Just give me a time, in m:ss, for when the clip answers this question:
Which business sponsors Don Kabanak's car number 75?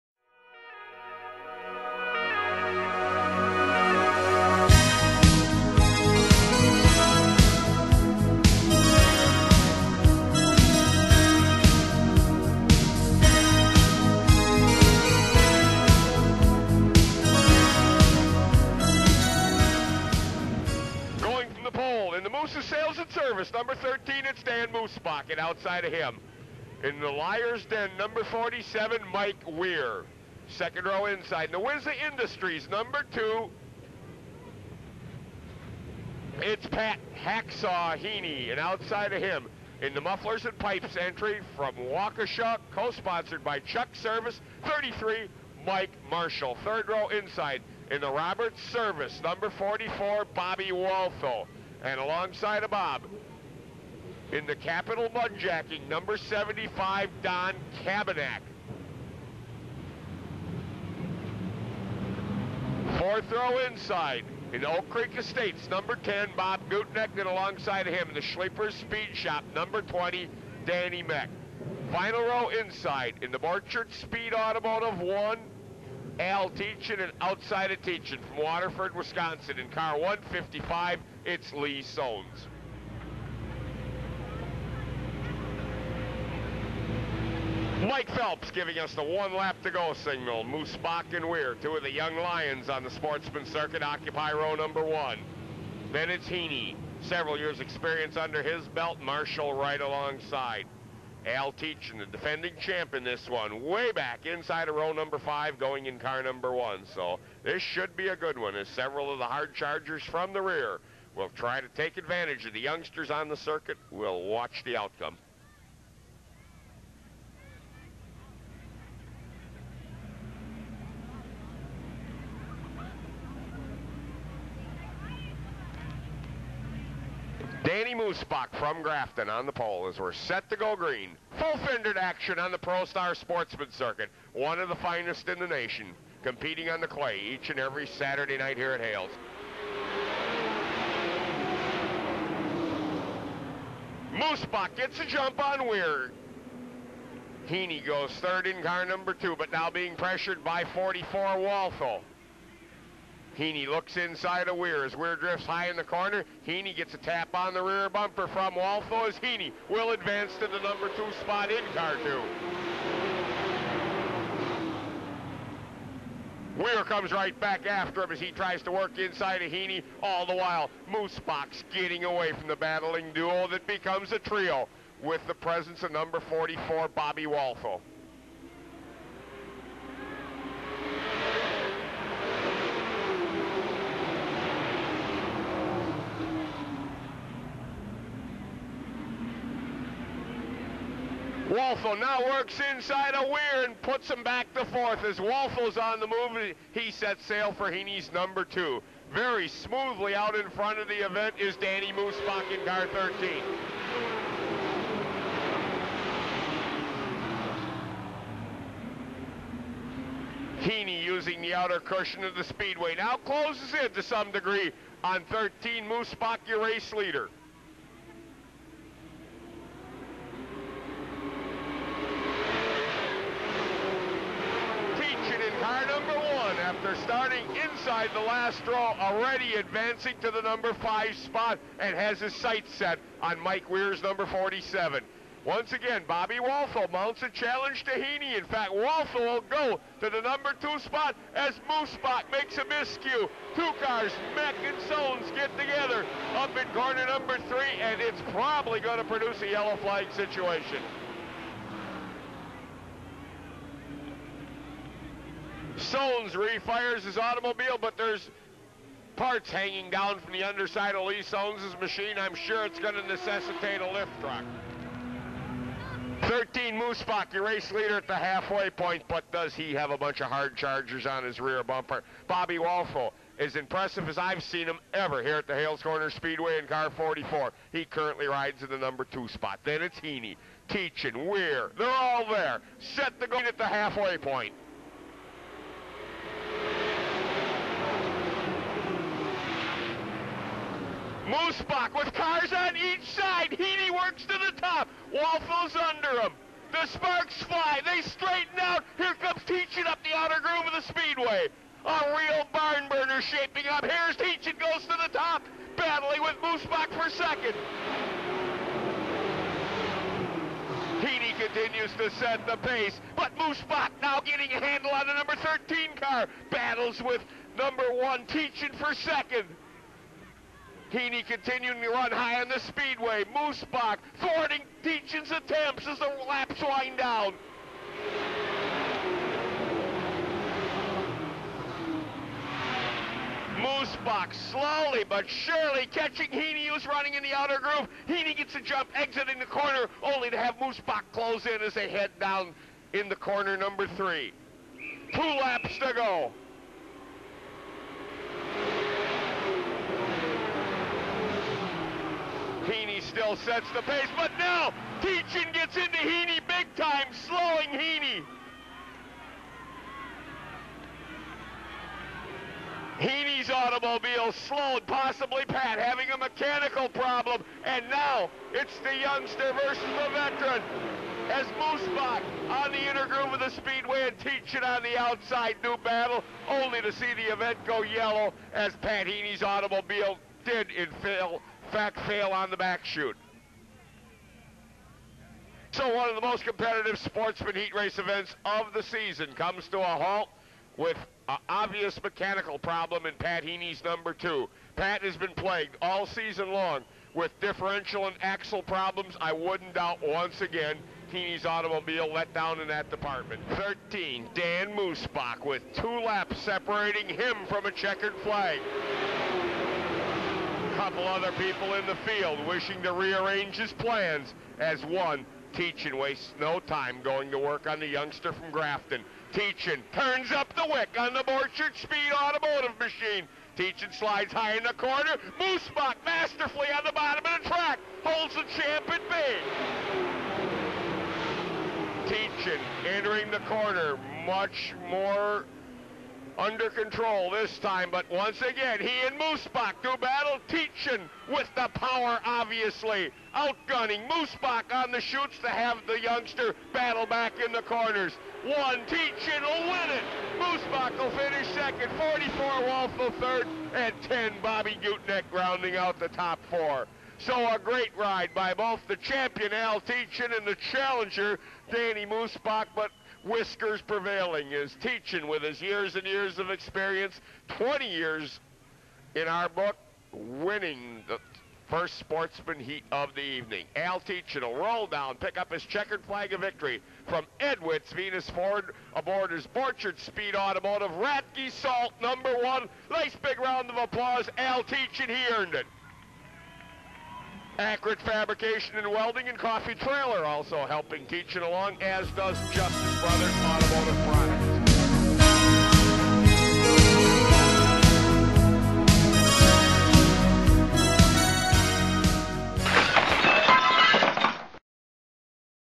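0:54.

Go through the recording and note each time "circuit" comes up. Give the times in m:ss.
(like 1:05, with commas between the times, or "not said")
1:33, 1:53, 2:13.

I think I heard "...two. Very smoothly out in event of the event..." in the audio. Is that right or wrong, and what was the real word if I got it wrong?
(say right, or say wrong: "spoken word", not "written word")
wrong: "front", not "event".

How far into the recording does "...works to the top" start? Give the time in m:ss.
4:53.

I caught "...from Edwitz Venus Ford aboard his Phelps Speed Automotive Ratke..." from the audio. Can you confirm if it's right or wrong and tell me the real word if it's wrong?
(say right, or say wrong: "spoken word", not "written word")
wrong: "Borchard", not "Phelps".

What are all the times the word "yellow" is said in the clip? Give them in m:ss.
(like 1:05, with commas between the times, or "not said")
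4:09, 6:17.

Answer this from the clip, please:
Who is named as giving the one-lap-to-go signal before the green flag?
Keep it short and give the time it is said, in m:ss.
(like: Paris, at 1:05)
Mike Phelps, at 1:27.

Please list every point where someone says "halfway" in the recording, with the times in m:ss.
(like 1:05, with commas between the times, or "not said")
4:28, 4:43.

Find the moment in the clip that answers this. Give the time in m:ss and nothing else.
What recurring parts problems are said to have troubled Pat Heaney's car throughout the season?
6:37.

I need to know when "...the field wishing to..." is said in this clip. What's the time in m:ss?
6:51.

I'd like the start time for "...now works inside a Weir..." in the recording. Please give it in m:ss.
3:11.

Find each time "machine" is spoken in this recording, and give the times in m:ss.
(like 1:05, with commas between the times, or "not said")
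4:21, 7:02.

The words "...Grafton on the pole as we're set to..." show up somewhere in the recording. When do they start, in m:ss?
2:08.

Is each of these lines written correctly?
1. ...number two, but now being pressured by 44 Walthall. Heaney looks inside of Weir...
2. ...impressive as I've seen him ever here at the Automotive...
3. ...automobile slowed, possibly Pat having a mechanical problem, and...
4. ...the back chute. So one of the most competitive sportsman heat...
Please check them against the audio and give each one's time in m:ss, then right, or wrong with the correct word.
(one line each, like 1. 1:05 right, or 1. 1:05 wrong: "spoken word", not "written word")
1. 2:28 right
2. 4:33 wrong: "Hales", not "Automotive"
3. 6:03 right
4. 6:22 right.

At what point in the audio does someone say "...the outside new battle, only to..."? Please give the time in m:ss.
6:14.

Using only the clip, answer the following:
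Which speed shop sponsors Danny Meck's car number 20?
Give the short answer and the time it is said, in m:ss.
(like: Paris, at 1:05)
Sleepers Speed Shop, at 1:08.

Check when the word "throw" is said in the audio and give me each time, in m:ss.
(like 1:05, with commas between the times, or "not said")
1:03, 3:48.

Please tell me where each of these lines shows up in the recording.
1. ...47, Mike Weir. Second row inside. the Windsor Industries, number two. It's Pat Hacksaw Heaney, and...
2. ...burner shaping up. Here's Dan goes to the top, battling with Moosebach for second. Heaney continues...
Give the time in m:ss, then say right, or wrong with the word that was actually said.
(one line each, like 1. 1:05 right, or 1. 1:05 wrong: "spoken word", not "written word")
1. 0:28 right
2. 5:02 wrong: "Teachin", not "Dan".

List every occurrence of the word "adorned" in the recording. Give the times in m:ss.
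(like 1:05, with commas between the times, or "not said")
not said.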